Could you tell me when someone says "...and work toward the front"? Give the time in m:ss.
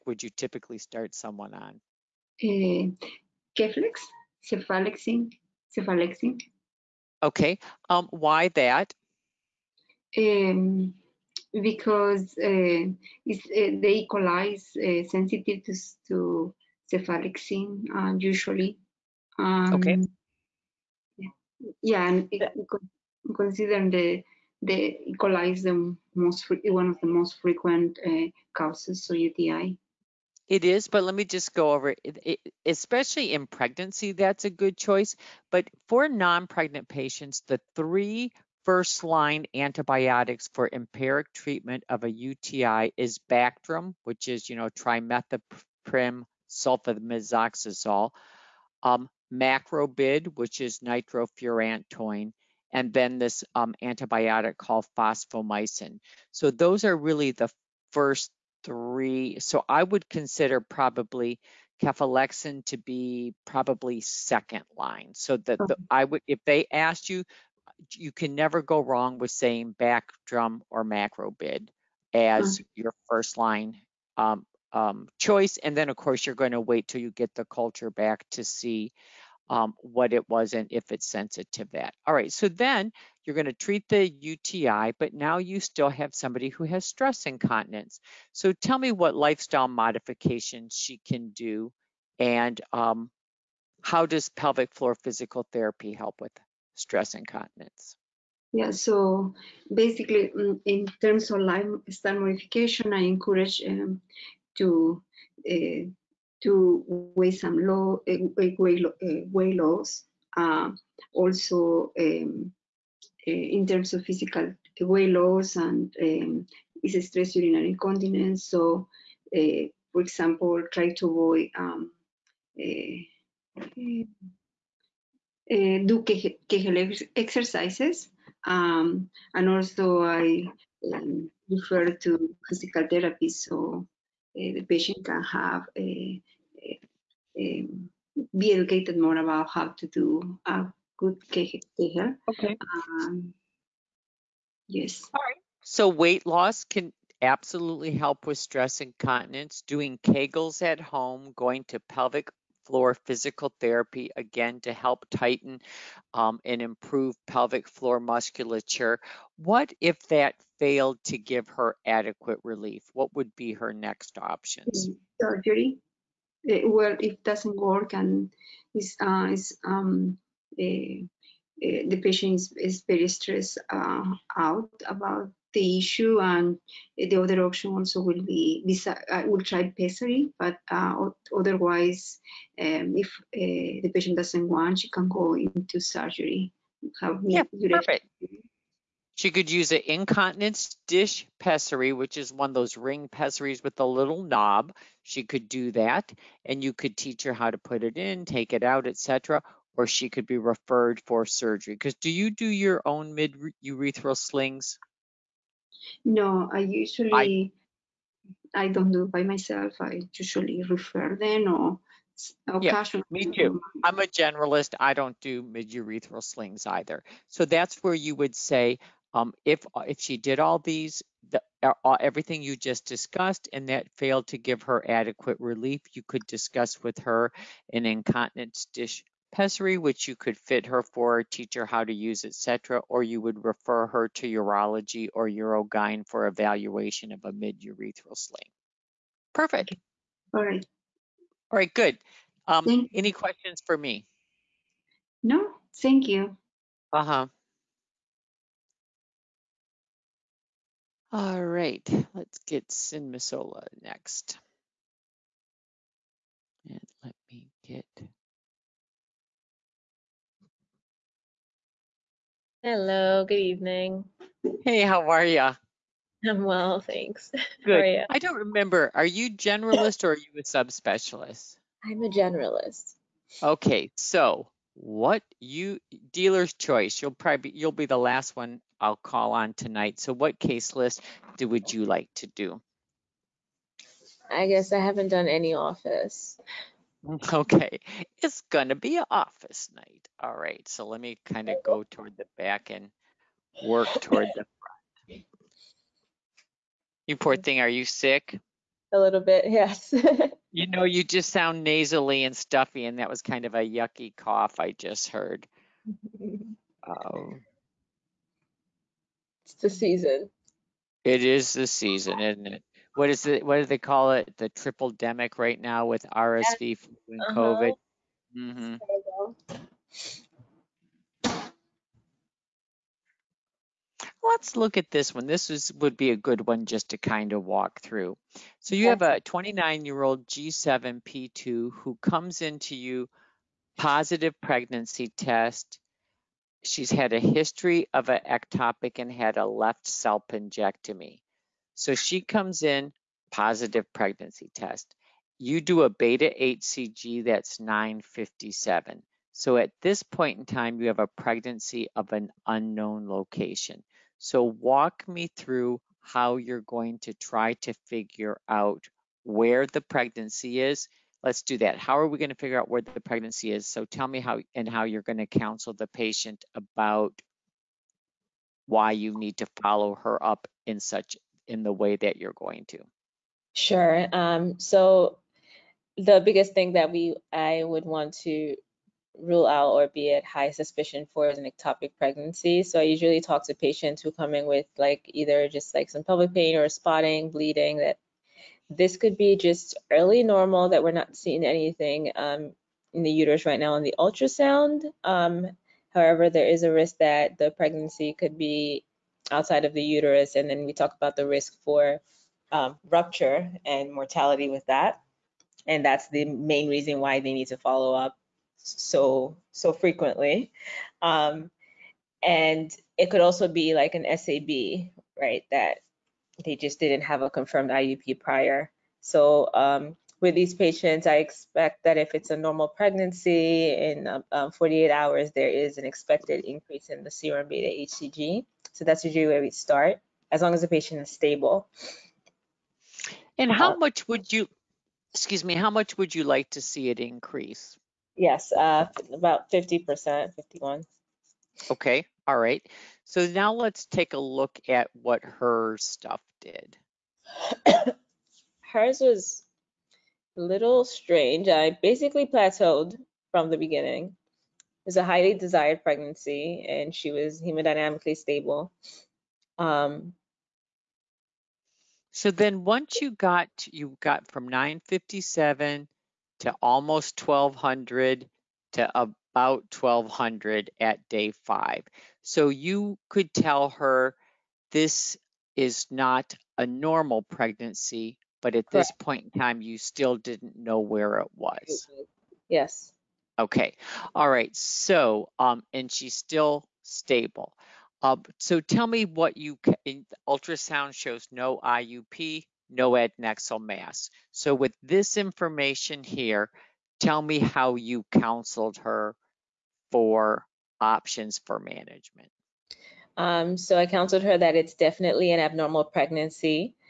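4:52.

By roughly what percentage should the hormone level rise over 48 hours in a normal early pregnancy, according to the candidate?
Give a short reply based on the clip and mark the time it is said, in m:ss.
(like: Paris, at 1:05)
50%, at 7:19.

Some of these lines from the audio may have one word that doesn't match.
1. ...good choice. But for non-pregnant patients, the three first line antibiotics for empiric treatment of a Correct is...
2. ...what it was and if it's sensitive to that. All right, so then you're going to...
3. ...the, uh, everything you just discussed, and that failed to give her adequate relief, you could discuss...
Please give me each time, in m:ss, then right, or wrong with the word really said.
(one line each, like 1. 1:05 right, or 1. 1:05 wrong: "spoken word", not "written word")
1. 0:34 wrong: "UTI", not "Correct"
2. 1:19 right
3. 3:41 right.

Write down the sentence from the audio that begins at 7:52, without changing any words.
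So you could tell her this is not a normal pregnancy, but at Correct.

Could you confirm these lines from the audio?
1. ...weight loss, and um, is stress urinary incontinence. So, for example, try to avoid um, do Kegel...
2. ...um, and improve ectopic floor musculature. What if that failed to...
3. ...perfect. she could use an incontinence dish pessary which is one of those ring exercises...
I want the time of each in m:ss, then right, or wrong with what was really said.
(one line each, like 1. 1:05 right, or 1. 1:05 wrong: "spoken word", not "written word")
1. 1:54 right
2. 2:36 wrong: "pelvic", not "ectopic"
3. 3:07 wrong: "pessaries", not "exercises".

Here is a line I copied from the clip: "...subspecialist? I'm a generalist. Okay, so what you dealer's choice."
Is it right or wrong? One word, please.
right.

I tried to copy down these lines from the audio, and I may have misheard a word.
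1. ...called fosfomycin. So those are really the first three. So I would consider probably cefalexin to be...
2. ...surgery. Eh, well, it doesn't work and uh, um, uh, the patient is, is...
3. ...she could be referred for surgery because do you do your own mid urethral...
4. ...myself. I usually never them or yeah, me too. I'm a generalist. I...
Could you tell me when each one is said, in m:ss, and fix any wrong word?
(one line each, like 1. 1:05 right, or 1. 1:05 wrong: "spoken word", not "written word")
1. 0:54 right
2. 2:45 right
3. 3:19 right
4. 3:29 wrong: "refer", not "never".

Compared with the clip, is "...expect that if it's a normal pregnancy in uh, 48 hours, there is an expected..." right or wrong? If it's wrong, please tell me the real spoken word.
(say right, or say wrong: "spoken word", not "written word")
right.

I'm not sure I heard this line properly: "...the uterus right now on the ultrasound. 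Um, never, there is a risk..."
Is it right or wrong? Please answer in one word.
wrong.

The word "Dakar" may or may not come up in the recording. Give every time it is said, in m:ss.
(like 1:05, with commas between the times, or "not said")
not said.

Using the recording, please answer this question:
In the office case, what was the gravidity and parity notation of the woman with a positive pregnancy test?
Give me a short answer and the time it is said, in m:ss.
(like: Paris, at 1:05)
G7P2, at 5:30.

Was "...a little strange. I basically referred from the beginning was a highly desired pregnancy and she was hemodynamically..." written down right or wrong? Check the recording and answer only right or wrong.
wrong.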